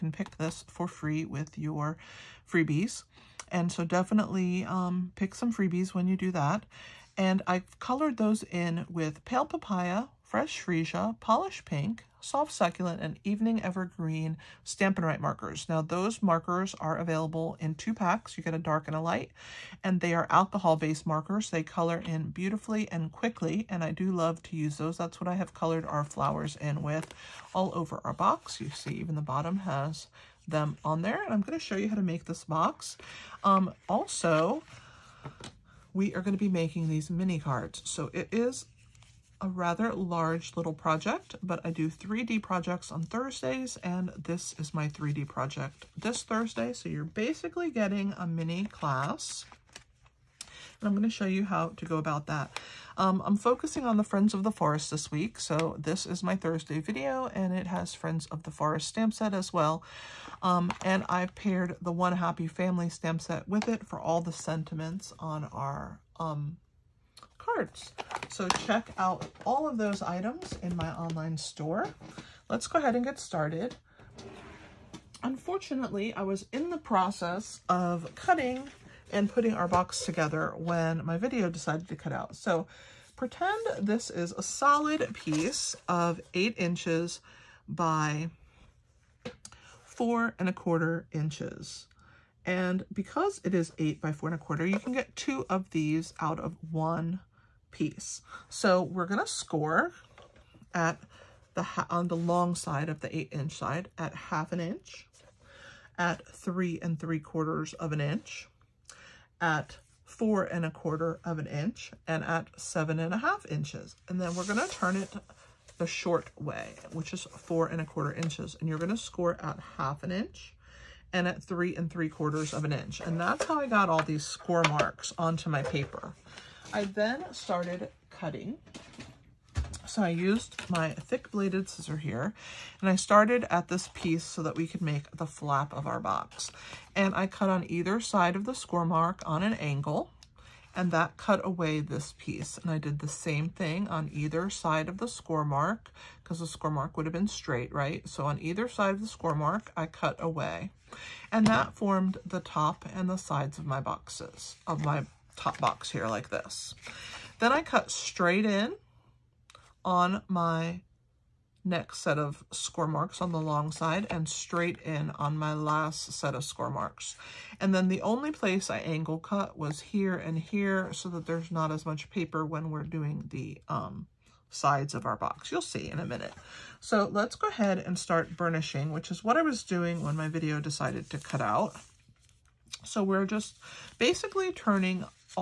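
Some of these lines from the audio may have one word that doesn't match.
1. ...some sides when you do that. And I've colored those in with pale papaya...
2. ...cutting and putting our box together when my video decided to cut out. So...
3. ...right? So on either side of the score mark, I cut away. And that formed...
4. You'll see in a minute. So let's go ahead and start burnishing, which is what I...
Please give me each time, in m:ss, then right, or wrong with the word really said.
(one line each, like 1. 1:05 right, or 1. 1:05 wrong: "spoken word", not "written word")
1. 0:05 wrong: "freebies", not "sides"
2. 1:18 right
3. 2:27 right
4. 2:55 right.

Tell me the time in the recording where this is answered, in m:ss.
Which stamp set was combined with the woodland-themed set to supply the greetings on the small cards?
1:01.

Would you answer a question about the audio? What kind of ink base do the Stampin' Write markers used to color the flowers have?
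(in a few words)
Alcohol-based.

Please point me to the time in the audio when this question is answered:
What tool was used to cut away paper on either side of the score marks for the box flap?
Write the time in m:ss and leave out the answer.
2:10.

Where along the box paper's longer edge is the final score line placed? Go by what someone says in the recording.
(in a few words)
7 1/2 inches.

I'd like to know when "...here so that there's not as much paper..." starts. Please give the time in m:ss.
2:50.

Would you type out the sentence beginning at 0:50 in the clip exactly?
And I'm going to show you how to go about that.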